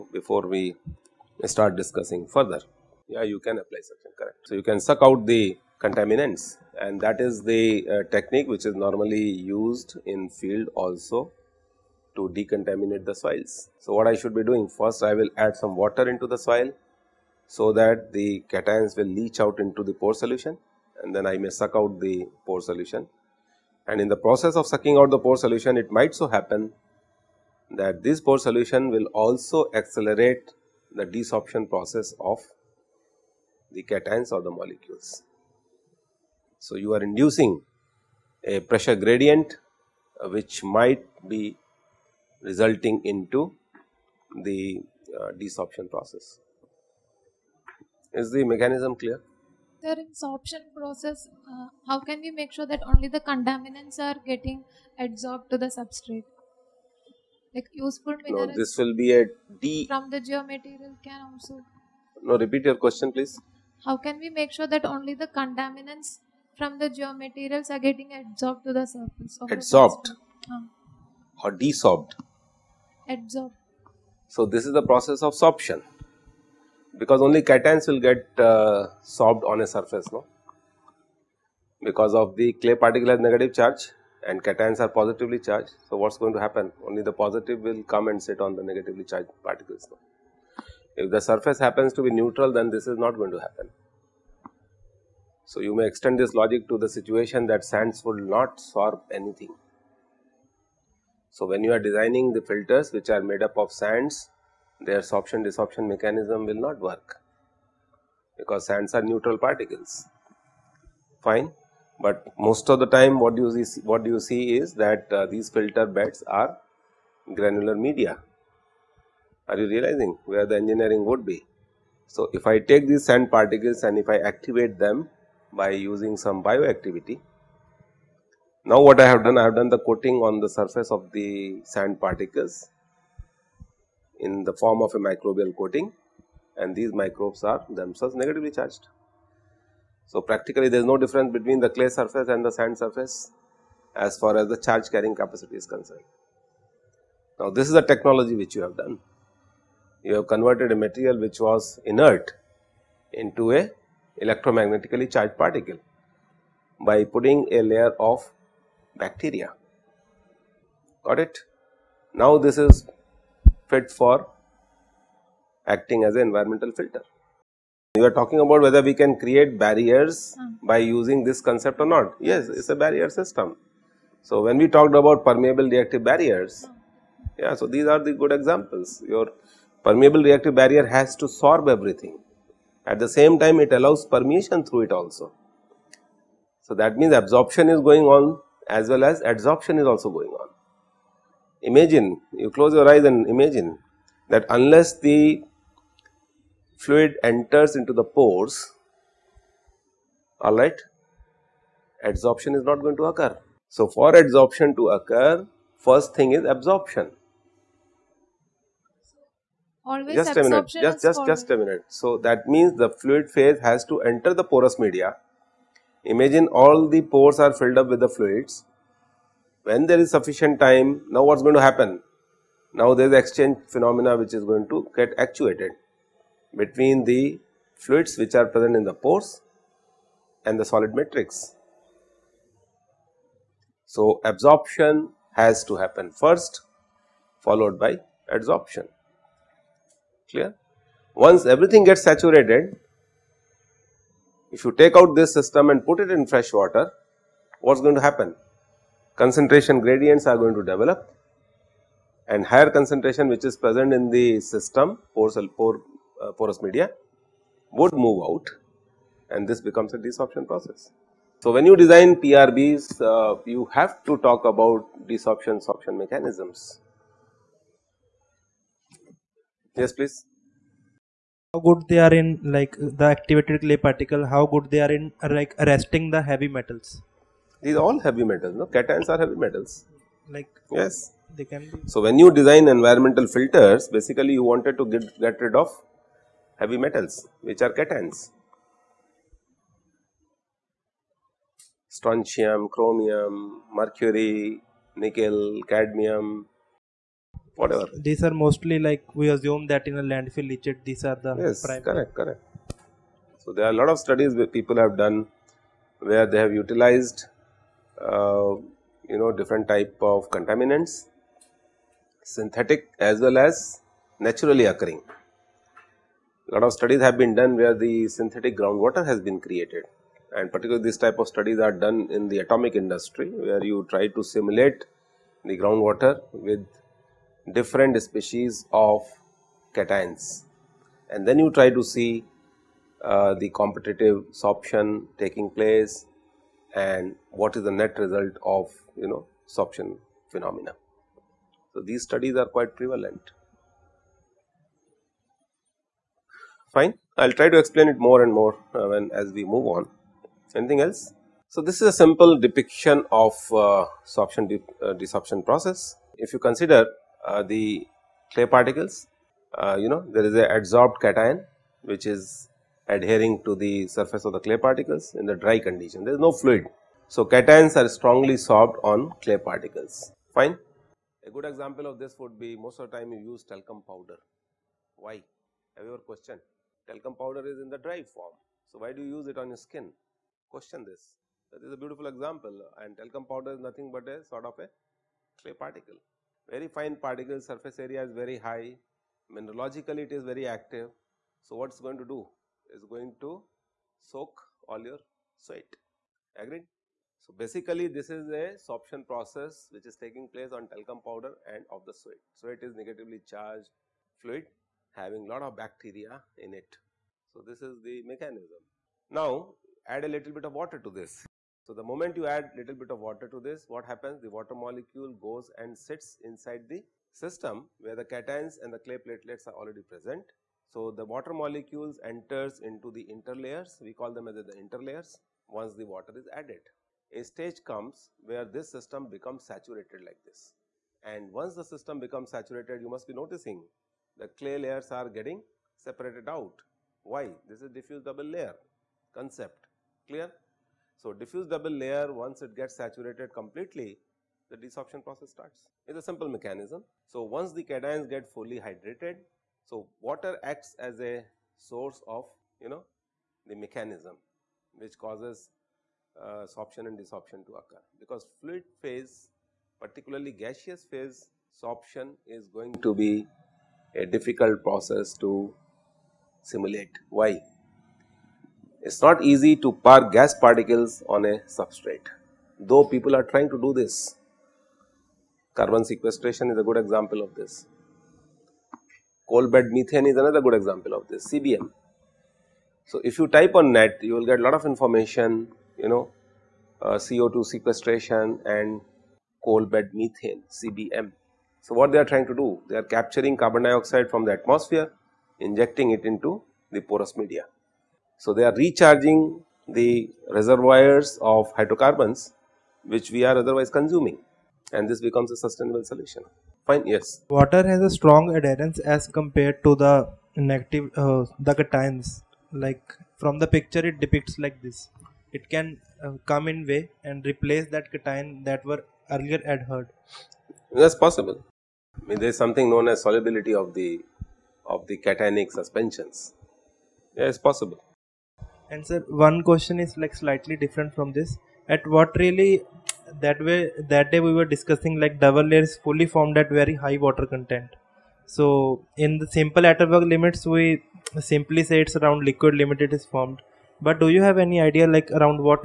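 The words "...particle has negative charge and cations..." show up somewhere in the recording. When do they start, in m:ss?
1:22.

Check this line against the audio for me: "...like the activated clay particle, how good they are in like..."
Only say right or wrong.
right.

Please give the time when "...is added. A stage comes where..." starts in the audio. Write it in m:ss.
7:06.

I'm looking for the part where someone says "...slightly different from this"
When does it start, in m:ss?
8:50.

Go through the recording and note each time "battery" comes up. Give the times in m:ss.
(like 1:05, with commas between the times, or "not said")
not said.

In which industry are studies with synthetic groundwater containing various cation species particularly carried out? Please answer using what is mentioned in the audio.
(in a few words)
Atomic industry.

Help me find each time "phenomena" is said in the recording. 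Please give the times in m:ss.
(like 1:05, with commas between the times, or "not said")
3:43, 5:40.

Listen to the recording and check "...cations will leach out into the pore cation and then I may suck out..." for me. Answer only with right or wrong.
wrong.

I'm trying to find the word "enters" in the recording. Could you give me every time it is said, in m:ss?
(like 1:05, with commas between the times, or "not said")
3:17, 3:34, 7:02.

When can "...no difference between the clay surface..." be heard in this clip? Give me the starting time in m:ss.
2:20.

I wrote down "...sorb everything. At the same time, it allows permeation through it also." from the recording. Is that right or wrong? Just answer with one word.
right.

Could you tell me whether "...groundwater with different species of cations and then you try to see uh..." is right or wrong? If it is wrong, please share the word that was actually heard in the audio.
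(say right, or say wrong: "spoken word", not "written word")
right.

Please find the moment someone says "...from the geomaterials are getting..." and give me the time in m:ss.
1:06.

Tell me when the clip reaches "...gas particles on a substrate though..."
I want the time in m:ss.
7:50.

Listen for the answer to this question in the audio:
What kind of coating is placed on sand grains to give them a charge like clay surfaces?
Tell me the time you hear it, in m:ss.
2:14.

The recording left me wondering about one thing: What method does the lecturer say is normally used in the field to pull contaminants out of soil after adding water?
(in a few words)
Suction.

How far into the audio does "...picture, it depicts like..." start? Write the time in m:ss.
8:33.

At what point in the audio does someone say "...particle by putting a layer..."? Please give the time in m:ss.
2:35.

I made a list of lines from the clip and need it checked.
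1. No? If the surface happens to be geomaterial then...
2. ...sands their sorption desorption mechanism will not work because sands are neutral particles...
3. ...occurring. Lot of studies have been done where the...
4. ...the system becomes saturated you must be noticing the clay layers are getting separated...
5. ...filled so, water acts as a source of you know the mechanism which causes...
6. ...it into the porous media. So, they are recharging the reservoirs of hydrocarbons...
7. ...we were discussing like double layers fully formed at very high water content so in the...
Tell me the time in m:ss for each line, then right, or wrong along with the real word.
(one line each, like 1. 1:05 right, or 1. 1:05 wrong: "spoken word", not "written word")
1. 1:29 wrong: "neutral", not "geomaterial"
2. 1:43 right
3. 5:14 right
4. 7:11 right
5. 7:28 wrong: "hydrated", not "filled"
6. 8:15 right
7. 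8:54 right.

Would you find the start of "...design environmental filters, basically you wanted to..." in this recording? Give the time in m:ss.
4:42.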